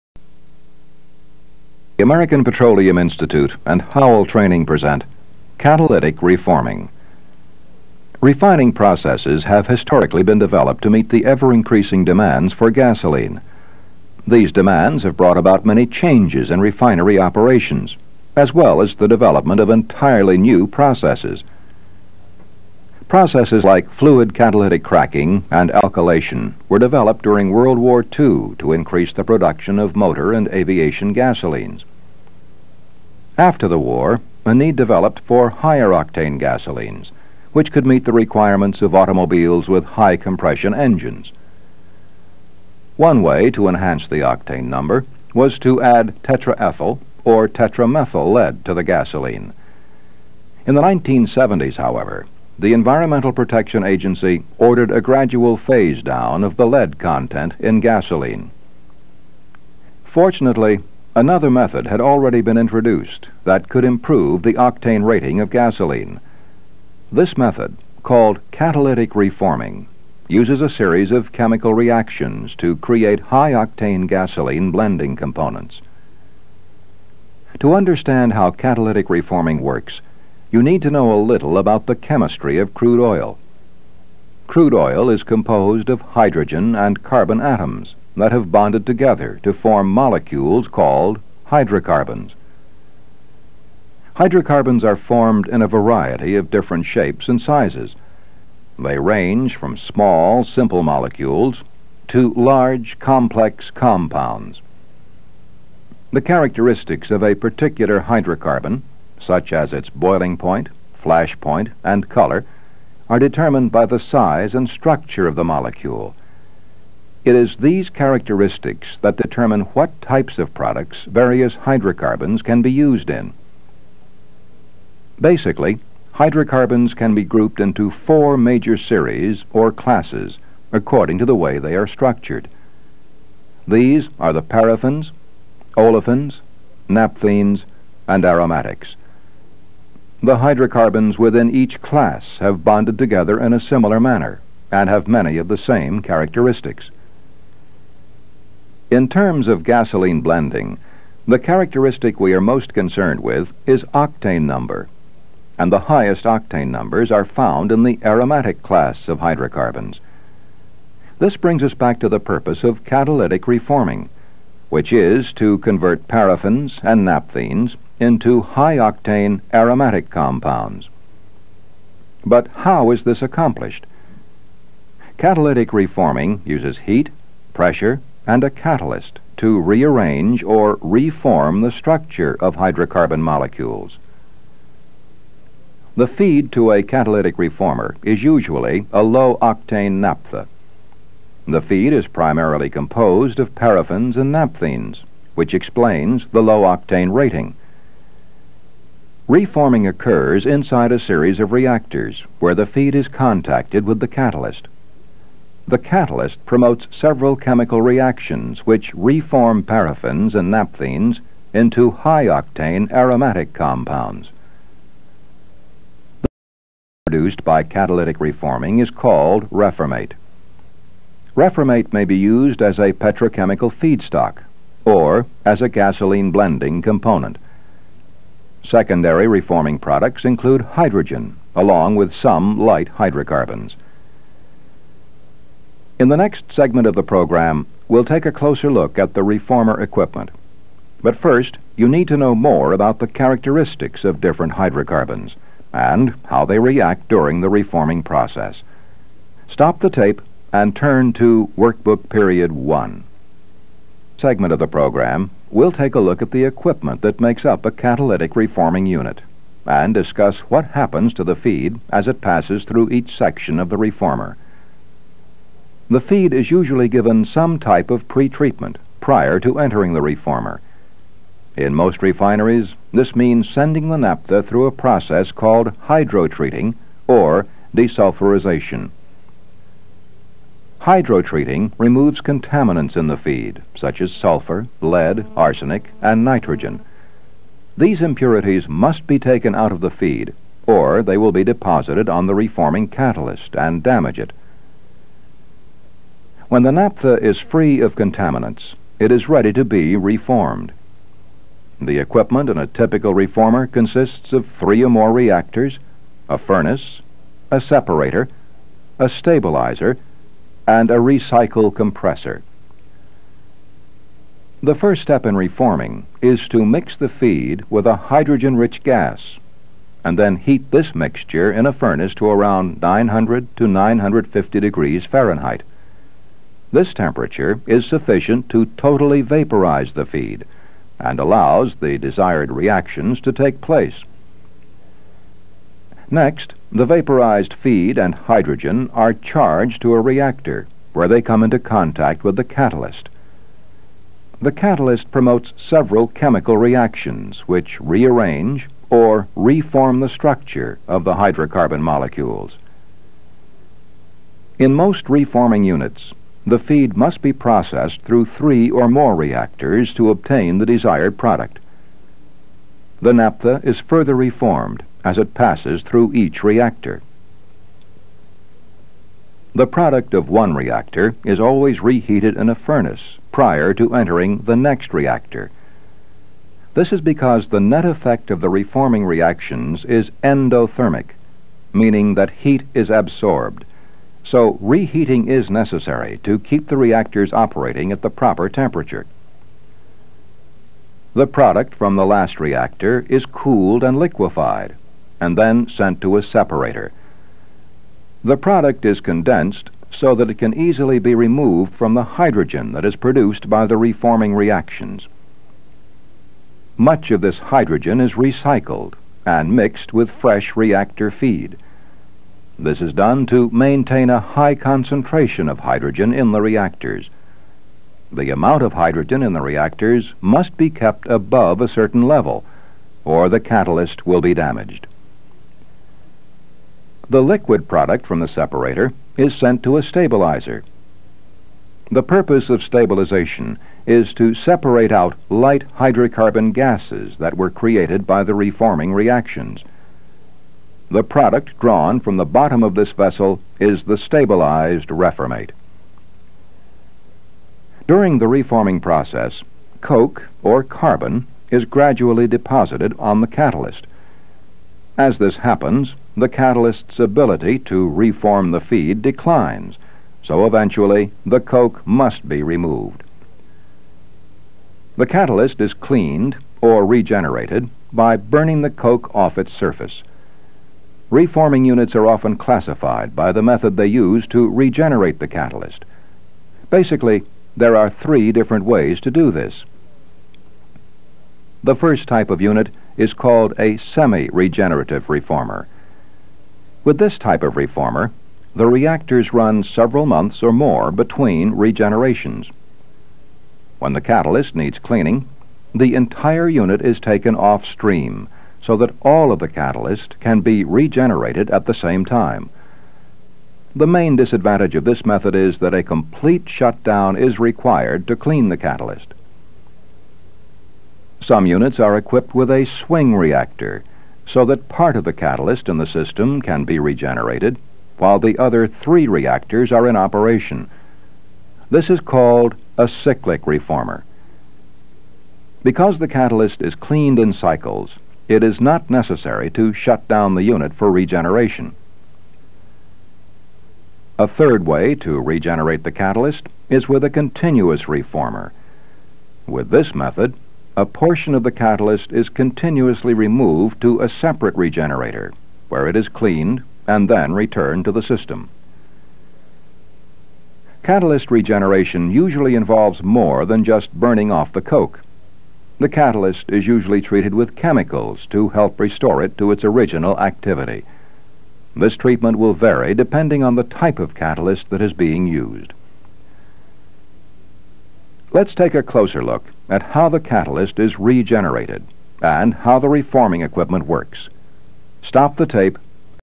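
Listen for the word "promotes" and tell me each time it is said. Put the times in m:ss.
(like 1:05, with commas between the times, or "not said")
3:26, 5:45.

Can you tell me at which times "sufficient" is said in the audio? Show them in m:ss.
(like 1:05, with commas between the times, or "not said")
5:27.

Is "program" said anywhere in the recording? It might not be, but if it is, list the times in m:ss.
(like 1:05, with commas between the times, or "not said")
3:57, 4:14.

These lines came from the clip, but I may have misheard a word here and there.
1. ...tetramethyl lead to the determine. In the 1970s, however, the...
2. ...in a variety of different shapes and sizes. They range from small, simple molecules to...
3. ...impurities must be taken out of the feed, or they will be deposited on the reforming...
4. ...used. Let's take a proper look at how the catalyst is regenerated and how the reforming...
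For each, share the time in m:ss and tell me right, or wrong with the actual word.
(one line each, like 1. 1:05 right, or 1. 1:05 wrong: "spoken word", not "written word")
1. 0:47 wrong: "gasoline", not "determine"
2. 1:35 right
3. 4:48 right
4. 9:25 wrong: "closer", not "proper".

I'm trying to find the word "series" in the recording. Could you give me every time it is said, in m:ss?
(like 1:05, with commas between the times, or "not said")
1:10, 2:08, 3:20.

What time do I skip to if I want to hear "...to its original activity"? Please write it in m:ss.
9:19.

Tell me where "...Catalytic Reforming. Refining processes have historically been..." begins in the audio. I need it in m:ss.
0:05.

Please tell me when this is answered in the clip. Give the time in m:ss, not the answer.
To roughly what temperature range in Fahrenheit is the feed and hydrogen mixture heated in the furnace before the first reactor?
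5:22.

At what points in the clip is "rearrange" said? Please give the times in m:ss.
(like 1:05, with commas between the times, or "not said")
2:59, 5:47.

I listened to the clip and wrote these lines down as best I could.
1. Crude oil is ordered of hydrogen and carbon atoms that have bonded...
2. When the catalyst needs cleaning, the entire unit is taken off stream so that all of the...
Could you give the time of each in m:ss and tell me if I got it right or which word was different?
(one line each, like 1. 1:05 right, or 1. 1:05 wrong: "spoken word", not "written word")
1. 1:24 wrong: "composed", not "ordered"
2. 8:13 right.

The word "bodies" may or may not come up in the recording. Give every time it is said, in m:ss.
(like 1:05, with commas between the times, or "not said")
not said.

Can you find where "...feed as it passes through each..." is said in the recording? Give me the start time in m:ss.
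4:21.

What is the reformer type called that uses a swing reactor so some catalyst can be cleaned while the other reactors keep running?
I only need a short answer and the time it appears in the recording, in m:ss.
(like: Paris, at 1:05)
cyclic reformer, at 8:42.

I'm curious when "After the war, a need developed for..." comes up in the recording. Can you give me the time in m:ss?
0:33.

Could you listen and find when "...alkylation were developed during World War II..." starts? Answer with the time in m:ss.
0:25.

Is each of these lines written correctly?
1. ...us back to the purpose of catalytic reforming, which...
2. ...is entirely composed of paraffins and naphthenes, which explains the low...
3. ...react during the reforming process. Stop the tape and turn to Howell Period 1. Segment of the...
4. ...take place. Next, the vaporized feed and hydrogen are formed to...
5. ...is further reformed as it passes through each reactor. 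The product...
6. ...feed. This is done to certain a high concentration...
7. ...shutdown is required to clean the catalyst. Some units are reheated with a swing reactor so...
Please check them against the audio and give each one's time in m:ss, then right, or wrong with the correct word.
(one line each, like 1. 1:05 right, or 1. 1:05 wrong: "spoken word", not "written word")
1. 2:41 right
2. 3:11 wrong: "primarily", not "entirely"
3. 4:06 wrong: "Workbook", not "Howell"
4. 5:33 wrong: "charged", not "formed"
5. 6:03 right
6. 6:51 wrong: "maintain", not "certain"
7. 8:26 wrong: "equipped", not "reheated".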